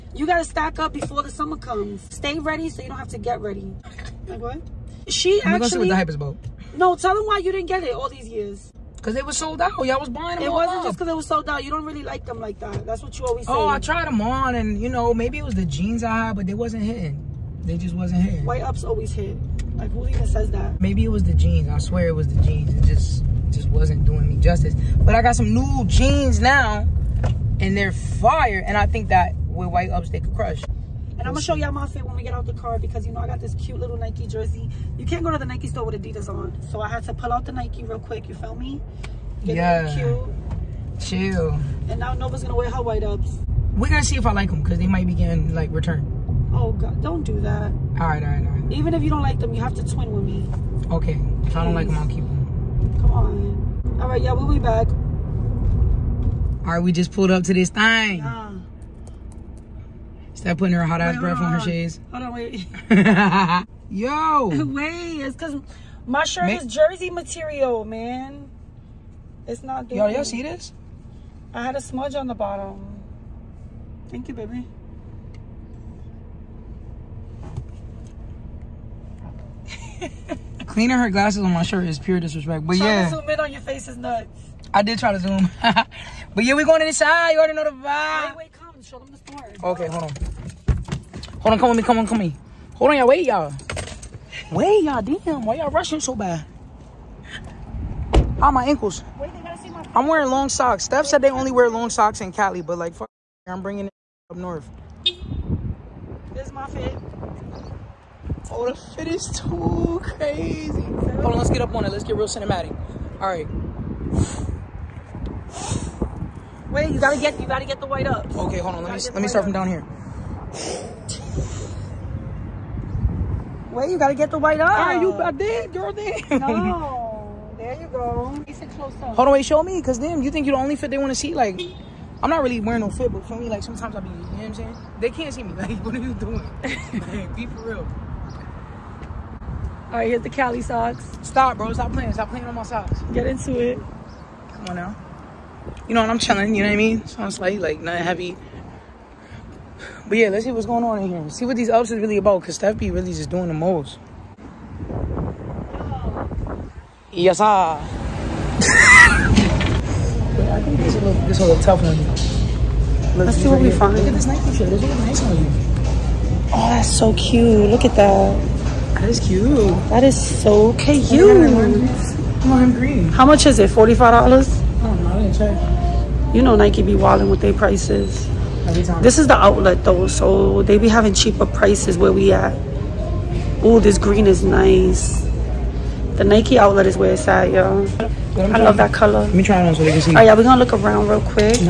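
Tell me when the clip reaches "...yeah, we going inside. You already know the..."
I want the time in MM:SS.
01:26.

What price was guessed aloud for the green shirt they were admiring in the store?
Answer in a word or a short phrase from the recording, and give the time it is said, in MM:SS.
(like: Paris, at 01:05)
$45, at 02:53.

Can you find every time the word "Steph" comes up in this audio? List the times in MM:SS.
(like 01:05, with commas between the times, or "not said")
01:40, 02:32.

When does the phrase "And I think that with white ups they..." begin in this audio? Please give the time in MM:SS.
00:28.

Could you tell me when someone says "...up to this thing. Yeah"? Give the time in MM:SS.
00:57.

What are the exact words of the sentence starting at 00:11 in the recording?
You don't really like them like that.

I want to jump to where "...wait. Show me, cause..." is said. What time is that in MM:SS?
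02:09.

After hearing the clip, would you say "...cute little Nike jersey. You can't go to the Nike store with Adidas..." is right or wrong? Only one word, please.
right.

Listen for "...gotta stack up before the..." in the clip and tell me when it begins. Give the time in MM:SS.
00:00.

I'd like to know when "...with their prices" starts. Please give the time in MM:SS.
02:57.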